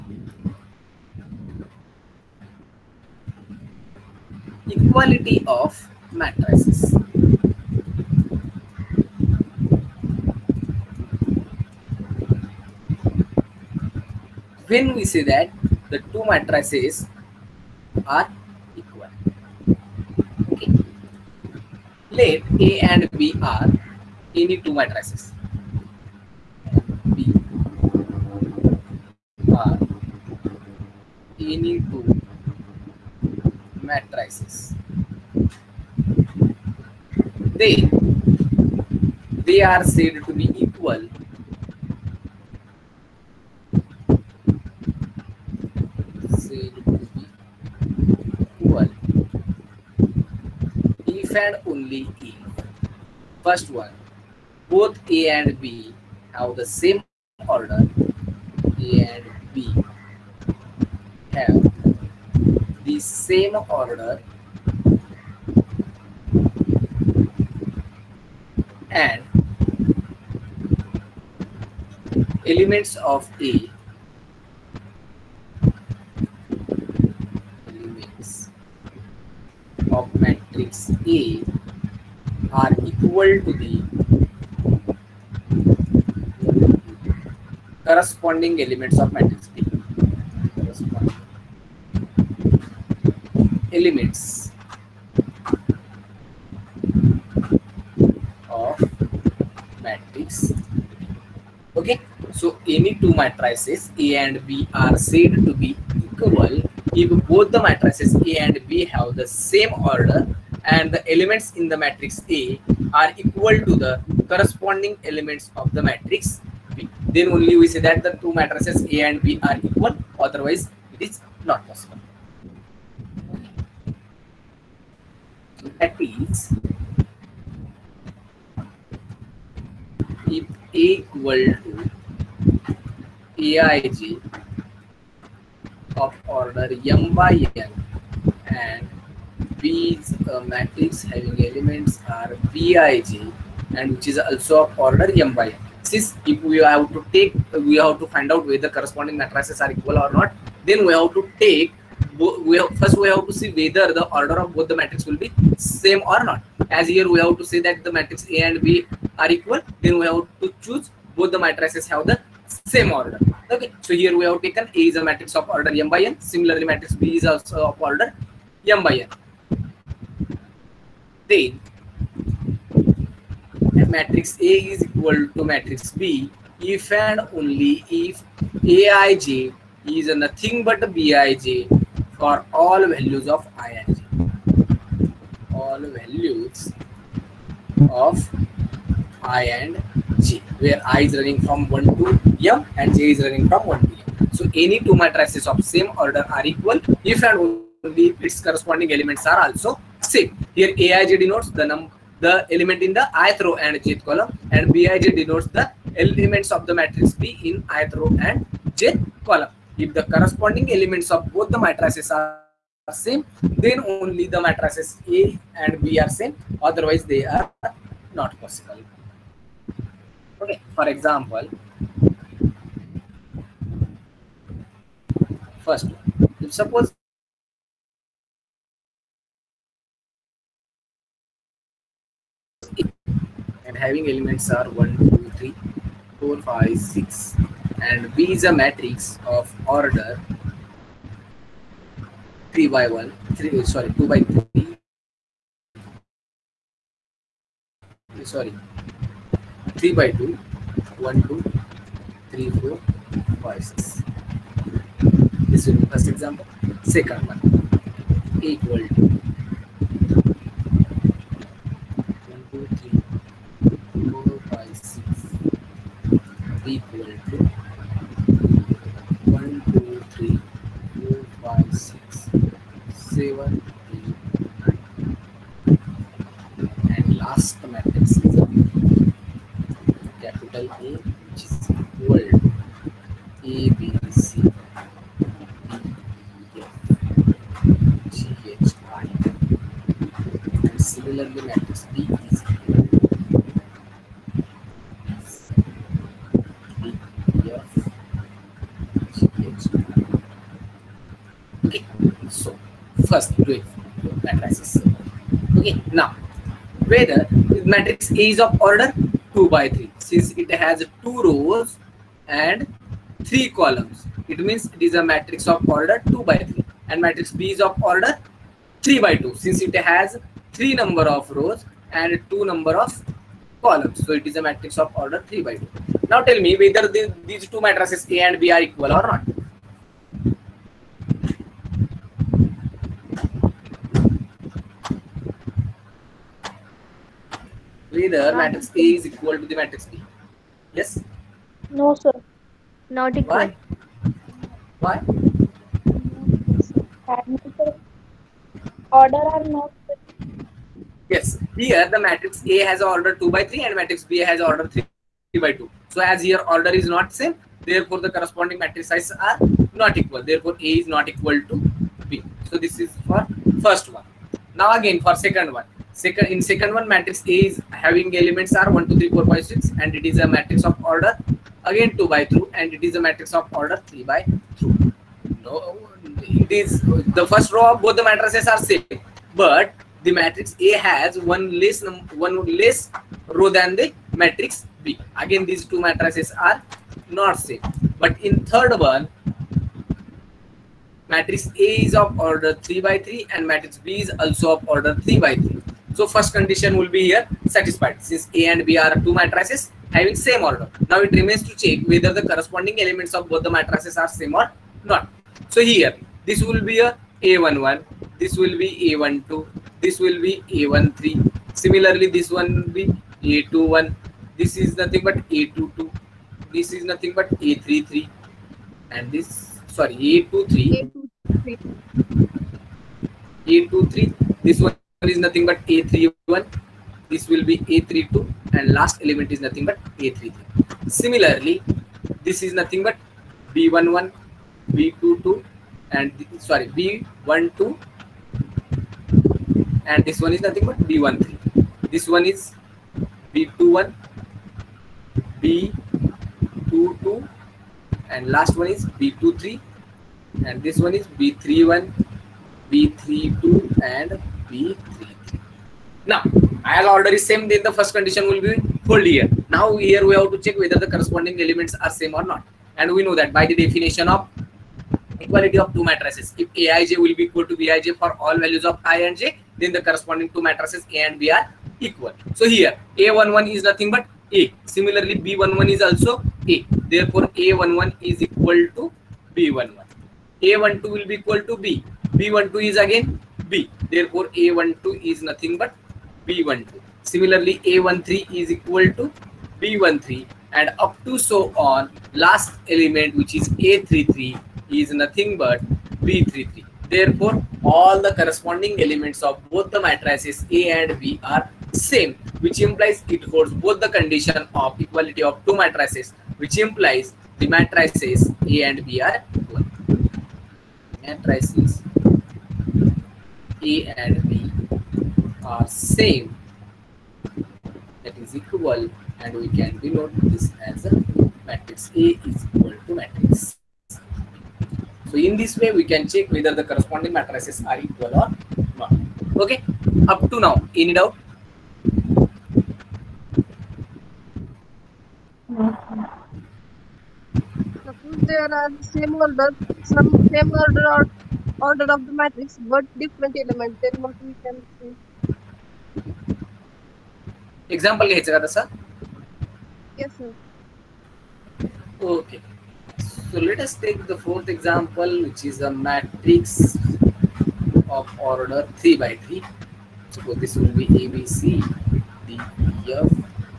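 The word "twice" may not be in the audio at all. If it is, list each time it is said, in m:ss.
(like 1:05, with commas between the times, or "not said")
not said.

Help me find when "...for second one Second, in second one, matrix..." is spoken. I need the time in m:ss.
6:05.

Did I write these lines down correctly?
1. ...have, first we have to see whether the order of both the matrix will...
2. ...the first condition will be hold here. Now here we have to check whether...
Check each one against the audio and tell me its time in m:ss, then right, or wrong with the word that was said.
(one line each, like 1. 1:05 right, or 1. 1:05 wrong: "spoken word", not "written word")
1. 2:32 right
2. 7:37 right.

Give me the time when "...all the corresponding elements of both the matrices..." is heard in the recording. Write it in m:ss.
8:17.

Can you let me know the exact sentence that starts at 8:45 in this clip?
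So in this way we can check whether the corresponding matrices are equal or not.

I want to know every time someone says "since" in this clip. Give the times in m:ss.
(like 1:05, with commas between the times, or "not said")
2:25, 5:09, 5:19, 6:38.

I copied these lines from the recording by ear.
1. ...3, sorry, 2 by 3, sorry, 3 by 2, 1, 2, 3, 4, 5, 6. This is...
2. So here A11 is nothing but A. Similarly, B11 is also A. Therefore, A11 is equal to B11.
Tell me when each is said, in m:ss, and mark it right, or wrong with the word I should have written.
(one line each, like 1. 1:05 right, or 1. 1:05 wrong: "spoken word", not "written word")
1. 4:03 right
2. 7:52 right.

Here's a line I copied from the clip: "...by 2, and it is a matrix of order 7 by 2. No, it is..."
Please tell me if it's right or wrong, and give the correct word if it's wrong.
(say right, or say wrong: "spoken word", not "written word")
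wrong: "3", not "7".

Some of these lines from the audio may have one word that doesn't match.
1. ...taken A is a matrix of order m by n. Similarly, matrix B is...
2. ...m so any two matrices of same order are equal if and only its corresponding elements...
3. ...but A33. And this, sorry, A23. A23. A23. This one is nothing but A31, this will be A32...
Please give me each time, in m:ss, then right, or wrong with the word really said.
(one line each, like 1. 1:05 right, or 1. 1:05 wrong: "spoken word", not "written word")
1. 2:44 right
2. 3:14 right
3. 6:57 right.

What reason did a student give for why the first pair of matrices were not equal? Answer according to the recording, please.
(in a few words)
Order are not.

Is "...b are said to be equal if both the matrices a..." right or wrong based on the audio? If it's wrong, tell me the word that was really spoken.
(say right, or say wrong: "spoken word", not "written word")
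right.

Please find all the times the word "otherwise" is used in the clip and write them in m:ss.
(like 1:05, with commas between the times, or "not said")
2:00, 3:36.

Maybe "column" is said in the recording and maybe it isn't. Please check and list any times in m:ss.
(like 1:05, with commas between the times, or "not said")
3:24, 3:29, 5:13, 5:23.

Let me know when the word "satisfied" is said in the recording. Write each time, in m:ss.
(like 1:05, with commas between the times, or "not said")
6:37.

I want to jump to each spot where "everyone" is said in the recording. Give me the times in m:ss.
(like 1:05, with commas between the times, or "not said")
4:33.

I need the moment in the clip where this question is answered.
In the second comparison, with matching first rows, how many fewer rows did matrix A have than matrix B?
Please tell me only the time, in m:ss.
6:22.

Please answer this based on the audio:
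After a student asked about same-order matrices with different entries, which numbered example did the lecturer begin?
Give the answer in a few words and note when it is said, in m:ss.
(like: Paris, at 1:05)
fourth, at 9:14.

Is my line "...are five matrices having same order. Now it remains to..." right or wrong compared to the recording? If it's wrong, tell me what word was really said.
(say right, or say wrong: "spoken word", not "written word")
wrong: "two", not "five".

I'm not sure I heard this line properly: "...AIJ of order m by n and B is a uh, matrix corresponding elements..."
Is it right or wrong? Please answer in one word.
wrong.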